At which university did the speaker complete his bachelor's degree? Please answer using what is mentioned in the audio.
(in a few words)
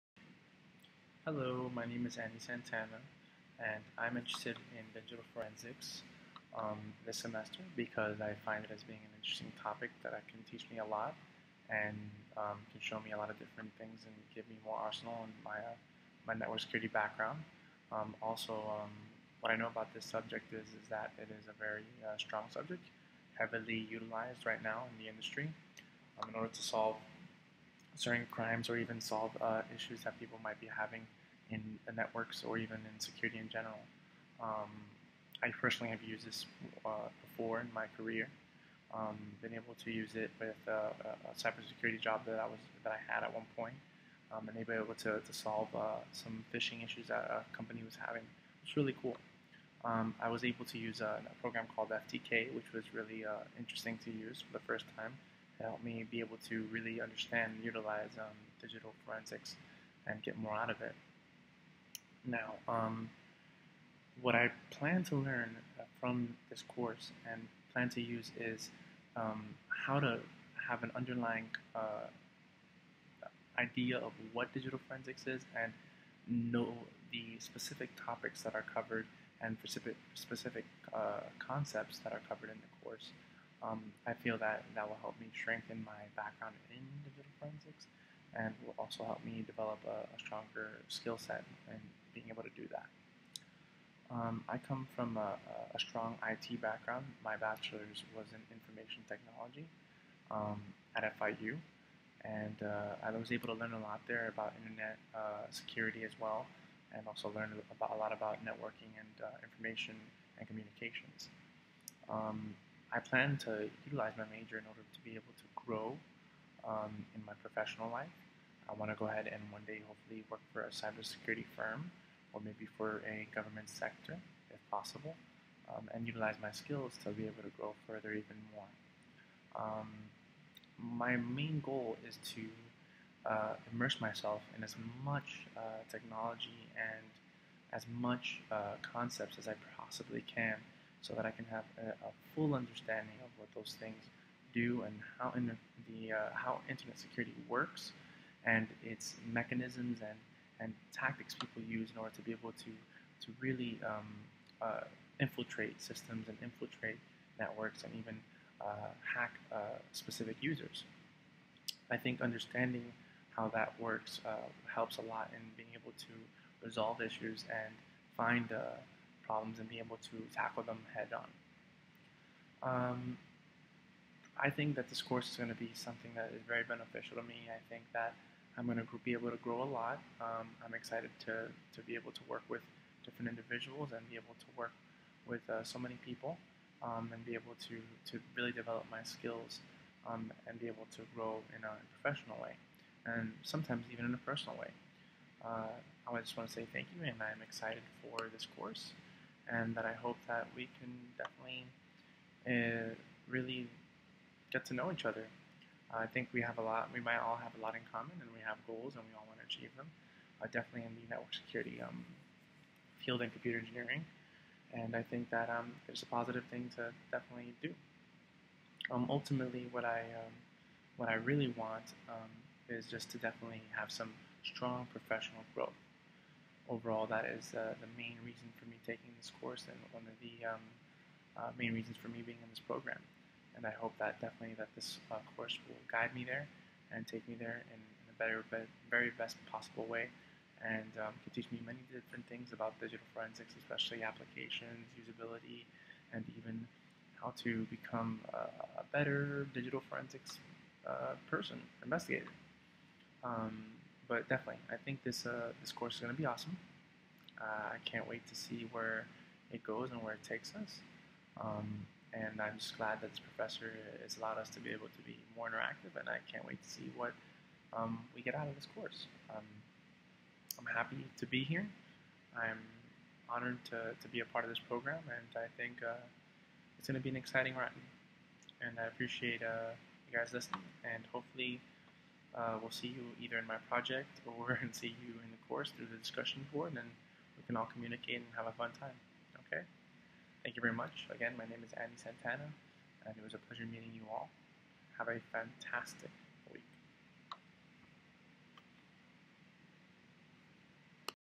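FIU.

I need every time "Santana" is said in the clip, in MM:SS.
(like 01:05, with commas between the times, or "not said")
00:02, 04:51.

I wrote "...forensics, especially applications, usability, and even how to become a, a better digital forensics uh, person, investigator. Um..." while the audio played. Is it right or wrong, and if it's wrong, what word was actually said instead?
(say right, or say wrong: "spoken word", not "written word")
right.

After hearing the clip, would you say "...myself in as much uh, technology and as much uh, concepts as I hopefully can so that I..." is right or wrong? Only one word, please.
wrong.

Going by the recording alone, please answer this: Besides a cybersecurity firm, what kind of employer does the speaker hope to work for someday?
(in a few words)
Government sector.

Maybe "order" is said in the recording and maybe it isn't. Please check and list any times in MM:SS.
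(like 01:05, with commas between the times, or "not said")
00:26, 01:54, 02:31.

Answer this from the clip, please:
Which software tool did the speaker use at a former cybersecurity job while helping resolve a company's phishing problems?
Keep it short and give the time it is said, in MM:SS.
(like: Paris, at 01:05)
FTK, at 00:51.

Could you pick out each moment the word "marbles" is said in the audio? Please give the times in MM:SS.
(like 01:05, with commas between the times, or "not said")
not said.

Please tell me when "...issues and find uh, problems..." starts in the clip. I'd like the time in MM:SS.
02:47.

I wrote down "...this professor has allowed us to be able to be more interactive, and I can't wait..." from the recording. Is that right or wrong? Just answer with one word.
right.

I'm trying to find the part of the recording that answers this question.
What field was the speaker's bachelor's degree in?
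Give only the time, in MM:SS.
01:38.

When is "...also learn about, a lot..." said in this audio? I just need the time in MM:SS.
01:47.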